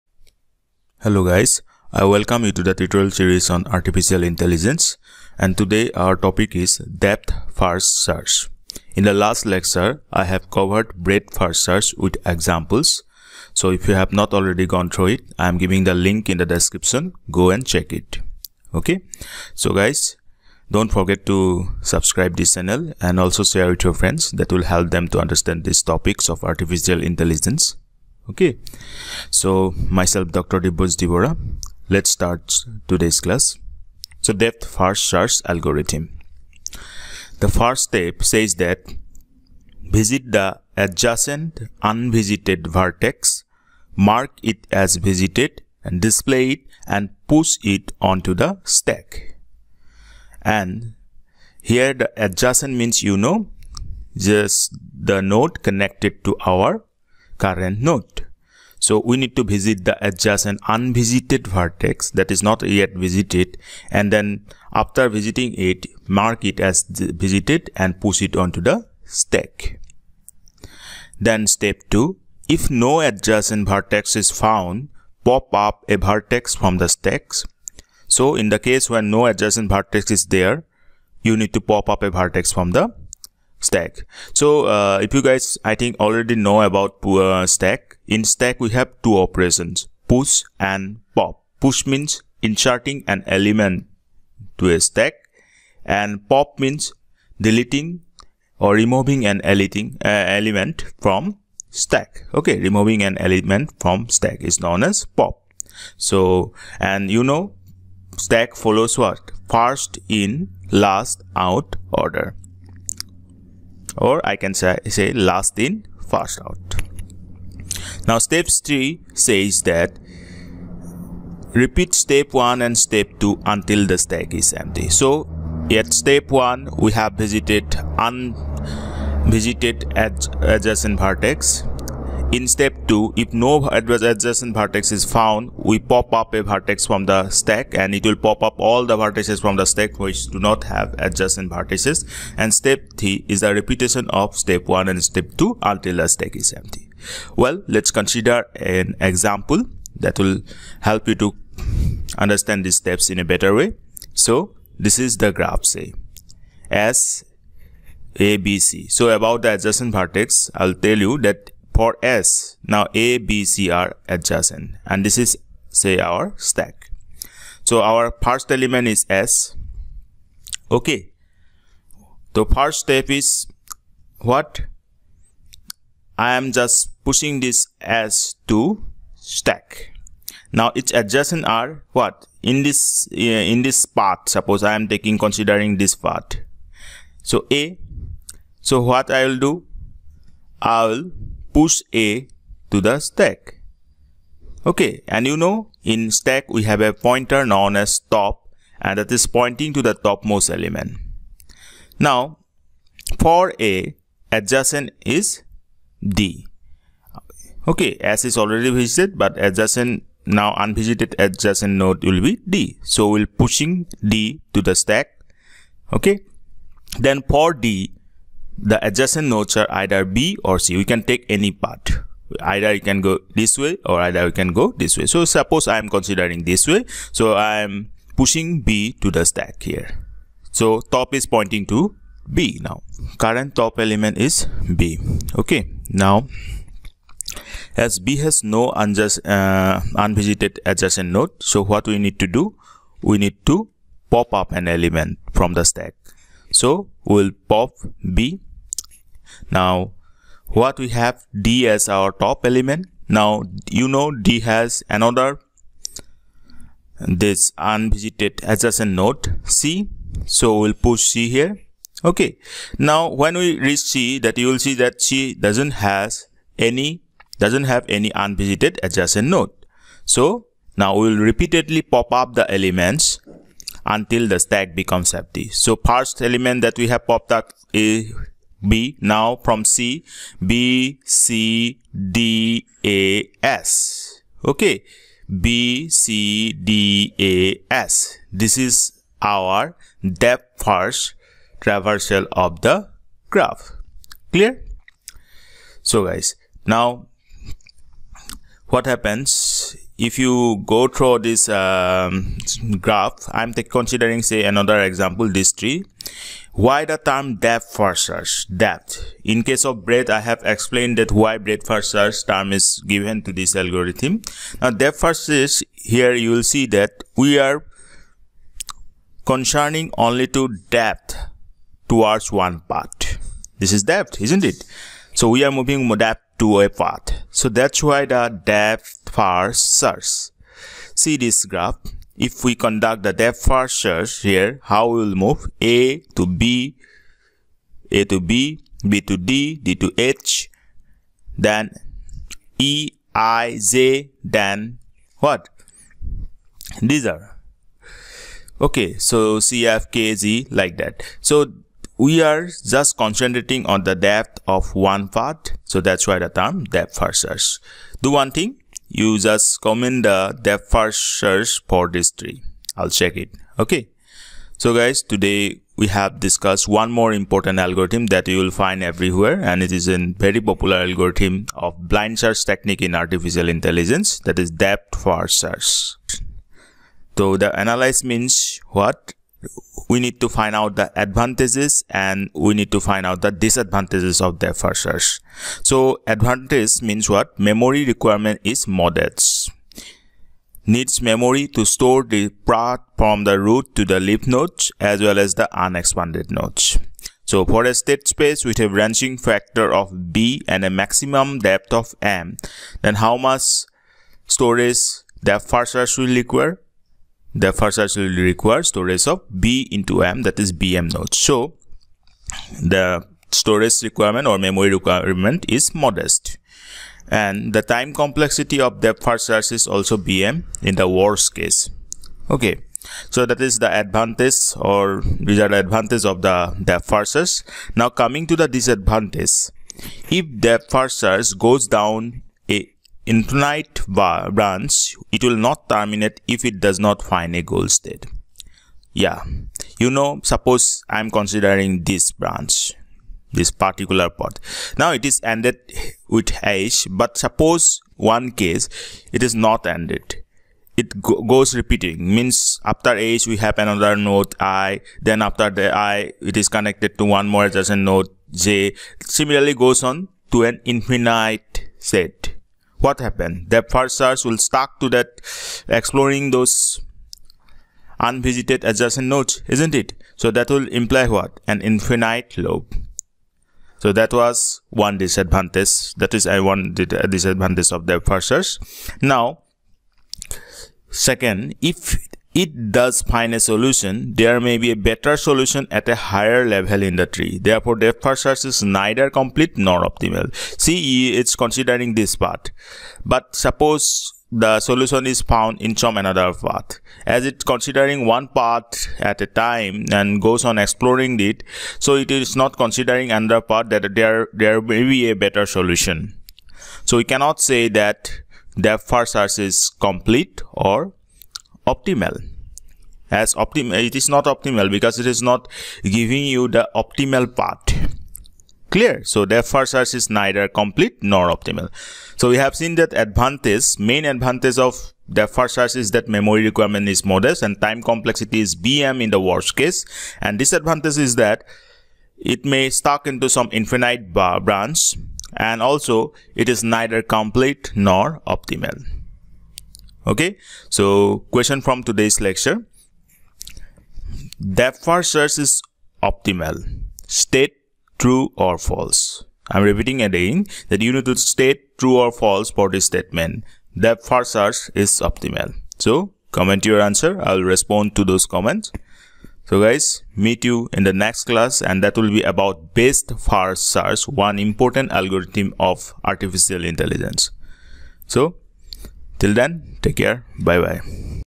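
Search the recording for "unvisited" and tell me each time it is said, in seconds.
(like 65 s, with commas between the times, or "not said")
41 s, 60 s, 127 s, 210 s, 239 s, 257 s, 268 s, 467 s.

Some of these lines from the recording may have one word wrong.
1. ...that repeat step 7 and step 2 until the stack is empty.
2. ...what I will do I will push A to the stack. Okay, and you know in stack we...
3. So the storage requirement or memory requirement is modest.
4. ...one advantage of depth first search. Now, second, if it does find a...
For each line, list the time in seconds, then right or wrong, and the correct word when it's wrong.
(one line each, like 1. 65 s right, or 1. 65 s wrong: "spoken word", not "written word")
1. 119 s wrong: "1", not "7"
2. 188 s right
3. 411 s right
4. 476 s wrong: "disadvantage", not "advantage".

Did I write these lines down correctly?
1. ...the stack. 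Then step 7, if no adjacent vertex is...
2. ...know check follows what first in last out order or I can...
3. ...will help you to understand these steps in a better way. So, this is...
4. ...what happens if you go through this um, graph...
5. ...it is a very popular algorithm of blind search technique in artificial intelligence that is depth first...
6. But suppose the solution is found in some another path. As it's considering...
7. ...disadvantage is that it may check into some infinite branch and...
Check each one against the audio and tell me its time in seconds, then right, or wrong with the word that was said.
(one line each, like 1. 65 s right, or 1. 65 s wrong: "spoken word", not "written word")
1. 68 s wrong: "2", not "7"
2. 107 s wrong: "stack", not "check"
3. 150 s right
4. 298 s right
5. 369 s right
6. 493 s right
7. 530 s wrong: "stuck", not "check".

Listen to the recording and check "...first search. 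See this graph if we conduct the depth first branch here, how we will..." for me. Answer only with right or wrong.
wrong.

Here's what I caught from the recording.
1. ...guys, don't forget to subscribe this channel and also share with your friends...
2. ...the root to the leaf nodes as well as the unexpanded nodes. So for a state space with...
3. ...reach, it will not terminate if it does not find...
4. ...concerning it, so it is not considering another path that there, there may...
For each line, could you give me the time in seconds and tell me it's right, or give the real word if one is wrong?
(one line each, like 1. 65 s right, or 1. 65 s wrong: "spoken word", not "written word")
1. 19 s right
2. 393 s right
3. 434 s wrong: "branch", not "reach"
4. 500 s wrong: "exploring", not "concerning".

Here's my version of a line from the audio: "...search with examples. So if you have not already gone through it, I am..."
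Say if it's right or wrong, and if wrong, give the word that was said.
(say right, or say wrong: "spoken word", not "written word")
right.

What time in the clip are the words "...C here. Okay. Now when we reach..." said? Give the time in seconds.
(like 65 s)
261 s.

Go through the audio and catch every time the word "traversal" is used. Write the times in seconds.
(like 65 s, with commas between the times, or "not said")
291 s.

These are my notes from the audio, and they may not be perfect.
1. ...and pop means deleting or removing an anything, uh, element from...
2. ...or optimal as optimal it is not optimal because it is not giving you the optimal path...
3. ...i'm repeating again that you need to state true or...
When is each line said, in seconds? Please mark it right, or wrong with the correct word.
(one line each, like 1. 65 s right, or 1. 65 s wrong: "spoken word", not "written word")
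1. 95 s right
2. 510 s right
3. 549 s right.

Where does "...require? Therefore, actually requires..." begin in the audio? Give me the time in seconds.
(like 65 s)
406 s.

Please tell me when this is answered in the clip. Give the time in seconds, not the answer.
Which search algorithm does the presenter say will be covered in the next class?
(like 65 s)
562 s.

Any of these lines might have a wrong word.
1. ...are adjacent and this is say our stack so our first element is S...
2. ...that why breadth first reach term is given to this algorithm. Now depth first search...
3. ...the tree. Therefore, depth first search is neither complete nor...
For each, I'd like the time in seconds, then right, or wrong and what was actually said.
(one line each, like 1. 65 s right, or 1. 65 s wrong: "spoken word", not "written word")
1. 163 s right
2. 310 s wrong: "search", not "reach"
3. 486 s right.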